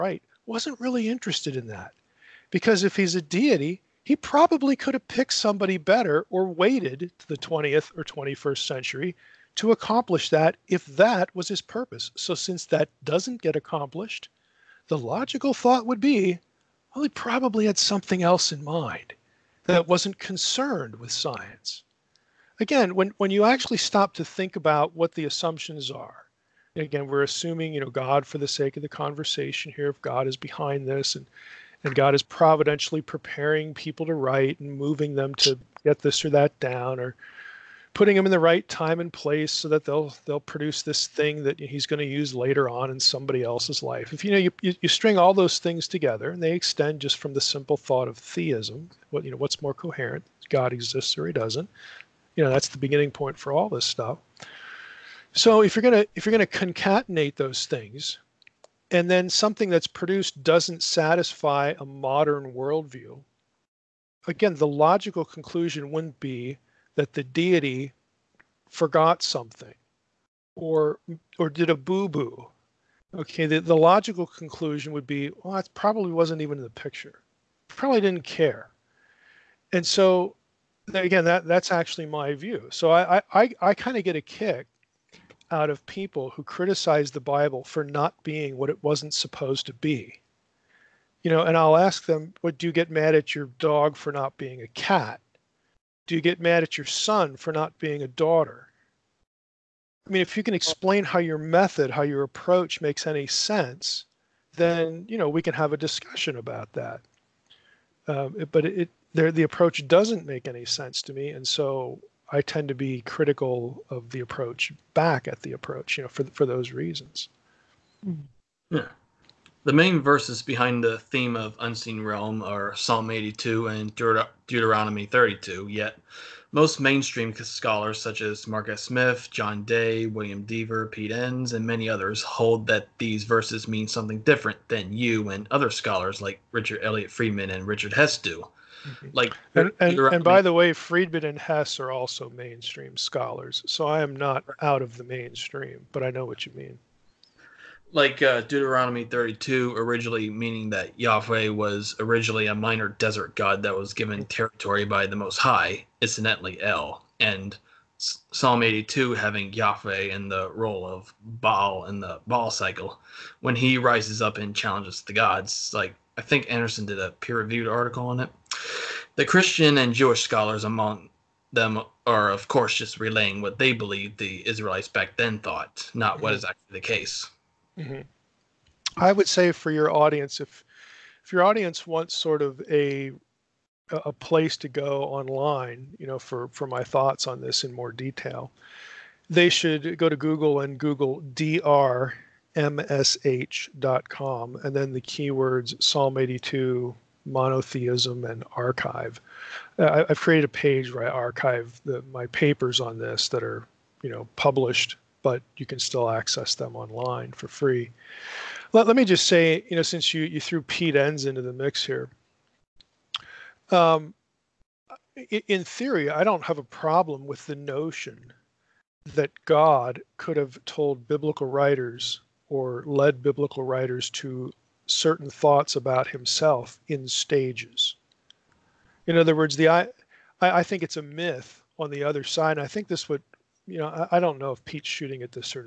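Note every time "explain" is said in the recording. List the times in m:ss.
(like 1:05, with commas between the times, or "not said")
1:40.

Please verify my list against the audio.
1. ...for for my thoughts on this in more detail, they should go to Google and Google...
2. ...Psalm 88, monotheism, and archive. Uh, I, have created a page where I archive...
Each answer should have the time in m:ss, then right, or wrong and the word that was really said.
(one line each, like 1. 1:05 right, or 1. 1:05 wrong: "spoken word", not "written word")
1. 3:06 right
2. 3:15 wrong: "82", not "88".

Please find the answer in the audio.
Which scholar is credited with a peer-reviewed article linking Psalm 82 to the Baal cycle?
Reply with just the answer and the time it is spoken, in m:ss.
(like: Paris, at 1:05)
Anderson, at 2:46.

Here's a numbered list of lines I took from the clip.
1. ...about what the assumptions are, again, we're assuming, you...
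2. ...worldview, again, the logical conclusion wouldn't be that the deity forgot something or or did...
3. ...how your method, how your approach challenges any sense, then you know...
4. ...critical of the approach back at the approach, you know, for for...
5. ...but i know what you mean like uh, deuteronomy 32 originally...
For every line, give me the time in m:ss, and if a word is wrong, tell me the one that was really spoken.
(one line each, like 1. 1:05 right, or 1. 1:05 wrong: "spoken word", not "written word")
1. 0:24 right
2. 1:02 right
3. 1:41 wrong: "makes", not "challenges"
4. 1:53 right
5. 2:25 right.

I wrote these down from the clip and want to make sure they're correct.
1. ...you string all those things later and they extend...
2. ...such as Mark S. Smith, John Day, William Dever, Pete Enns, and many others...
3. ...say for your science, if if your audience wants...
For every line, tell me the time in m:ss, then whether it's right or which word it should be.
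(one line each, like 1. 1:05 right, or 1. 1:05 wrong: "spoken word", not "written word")
1. 0:44 wrong: "together", not "later"
2. 2:08 right
3. 2:59 wrong: "audience", not "science".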